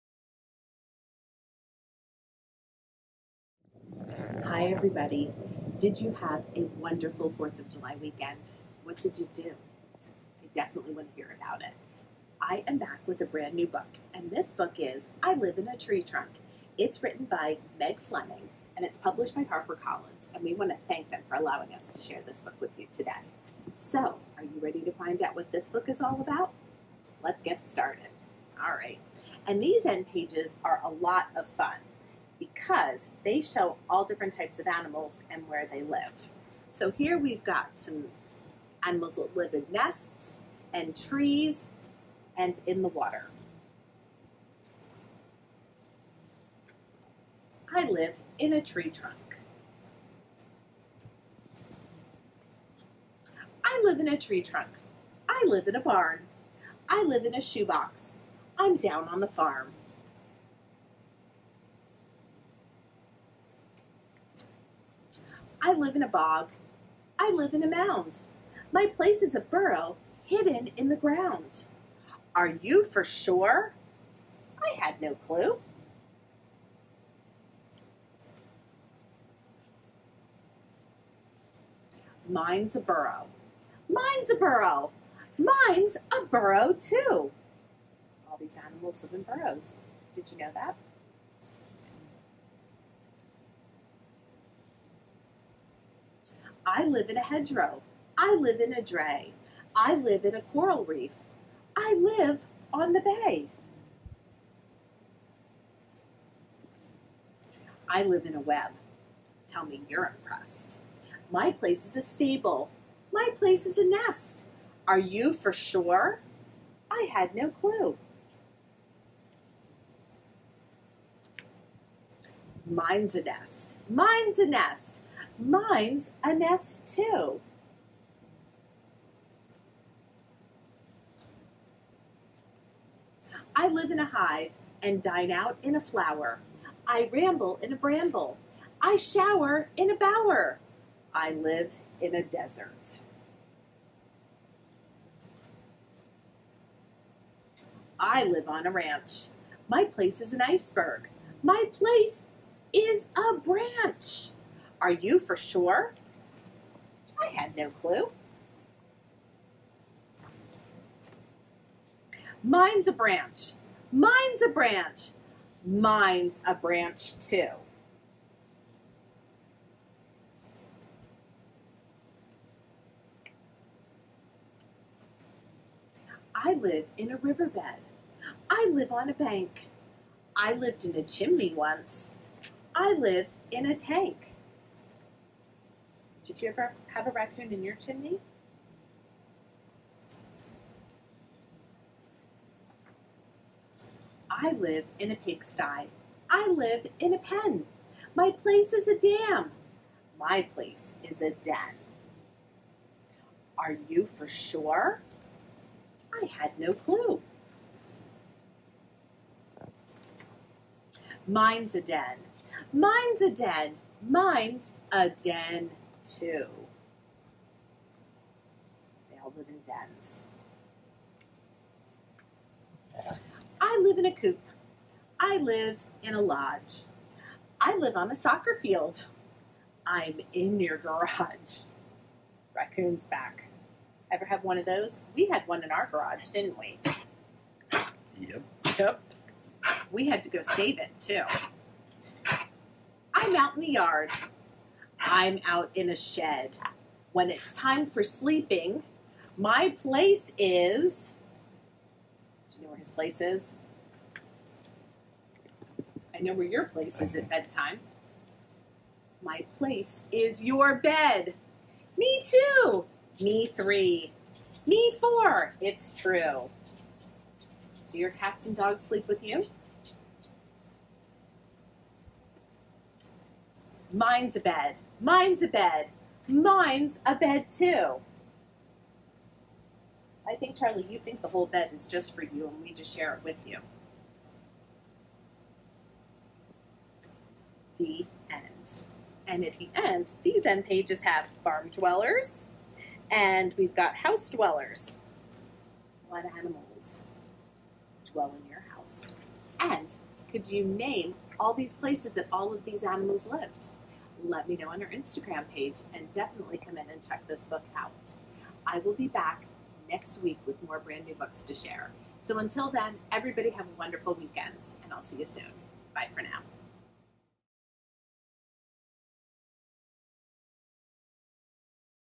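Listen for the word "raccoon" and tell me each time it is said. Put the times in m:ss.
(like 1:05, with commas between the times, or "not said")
3:07, 3:52.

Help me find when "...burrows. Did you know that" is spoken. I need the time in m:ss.
1:29.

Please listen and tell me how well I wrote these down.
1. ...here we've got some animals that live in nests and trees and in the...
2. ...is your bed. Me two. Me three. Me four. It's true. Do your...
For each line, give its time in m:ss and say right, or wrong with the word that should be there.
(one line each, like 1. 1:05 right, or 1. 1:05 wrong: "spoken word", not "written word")
1. 0:36 right
2. 4:20 right.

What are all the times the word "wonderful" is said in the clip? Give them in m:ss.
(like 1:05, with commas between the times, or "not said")
0:06, 5:13.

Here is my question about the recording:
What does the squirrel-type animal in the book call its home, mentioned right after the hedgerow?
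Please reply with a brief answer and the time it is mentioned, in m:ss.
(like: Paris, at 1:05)
dray, at 1:38.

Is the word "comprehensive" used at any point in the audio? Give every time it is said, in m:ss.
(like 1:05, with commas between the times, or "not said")
not said.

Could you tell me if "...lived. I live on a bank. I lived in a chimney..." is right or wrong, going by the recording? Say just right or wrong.
wrong.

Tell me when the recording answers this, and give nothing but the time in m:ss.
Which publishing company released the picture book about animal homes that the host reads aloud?
0:19.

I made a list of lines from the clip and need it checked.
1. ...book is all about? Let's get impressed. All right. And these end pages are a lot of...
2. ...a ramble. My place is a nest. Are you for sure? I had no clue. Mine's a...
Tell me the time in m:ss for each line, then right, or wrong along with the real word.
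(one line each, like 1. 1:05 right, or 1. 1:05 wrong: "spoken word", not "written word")
1. 0:25 wrong: "started", not "impressed"
2. 1:51 wrong: "stable", not "ramble".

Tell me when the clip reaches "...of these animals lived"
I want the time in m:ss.
5:02.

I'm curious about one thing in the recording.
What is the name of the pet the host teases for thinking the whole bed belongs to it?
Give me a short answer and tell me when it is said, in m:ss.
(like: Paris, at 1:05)
Charlie, at 4:40.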